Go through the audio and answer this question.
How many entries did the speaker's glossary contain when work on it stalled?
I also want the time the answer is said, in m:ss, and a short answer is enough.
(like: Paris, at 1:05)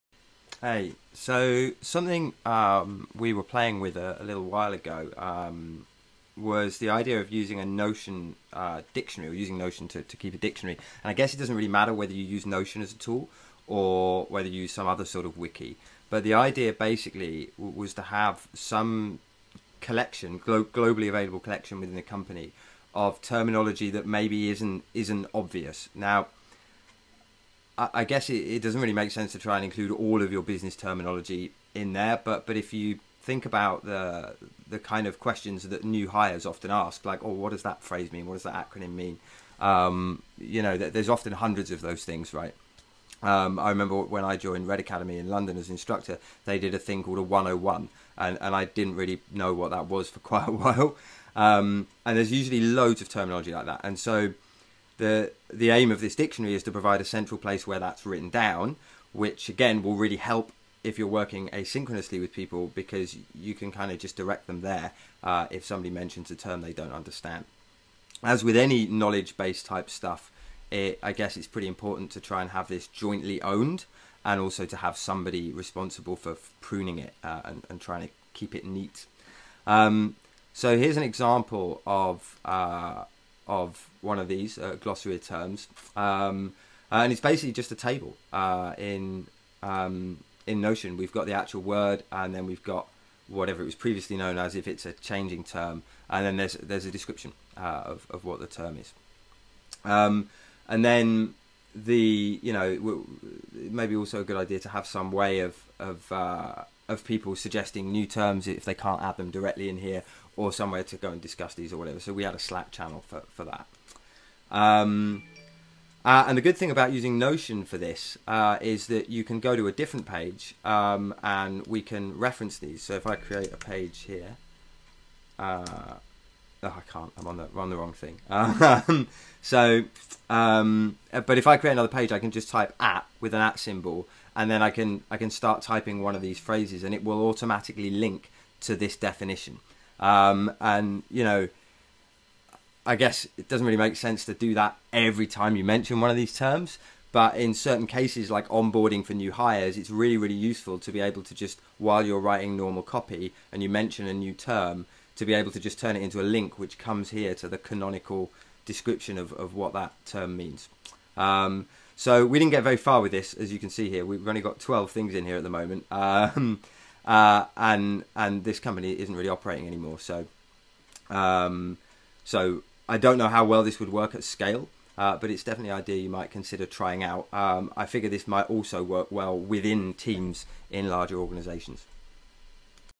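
12, at 2:44.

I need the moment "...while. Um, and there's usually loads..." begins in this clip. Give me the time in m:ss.
0:50.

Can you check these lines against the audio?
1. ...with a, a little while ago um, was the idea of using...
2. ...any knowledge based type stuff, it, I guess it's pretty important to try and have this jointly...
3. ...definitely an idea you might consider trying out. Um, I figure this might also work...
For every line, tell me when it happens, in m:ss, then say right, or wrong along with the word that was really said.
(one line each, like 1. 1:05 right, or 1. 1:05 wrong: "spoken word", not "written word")
1. 0:03 right
2. 1:08 right
3. 2:55 right.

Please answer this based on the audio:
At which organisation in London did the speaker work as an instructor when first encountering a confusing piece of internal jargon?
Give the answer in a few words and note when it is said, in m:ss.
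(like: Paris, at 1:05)
Red Academy, at 0:44.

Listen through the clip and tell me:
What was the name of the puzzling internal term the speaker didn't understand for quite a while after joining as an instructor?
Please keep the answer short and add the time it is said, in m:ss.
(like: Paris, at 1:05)
101, at 0:47.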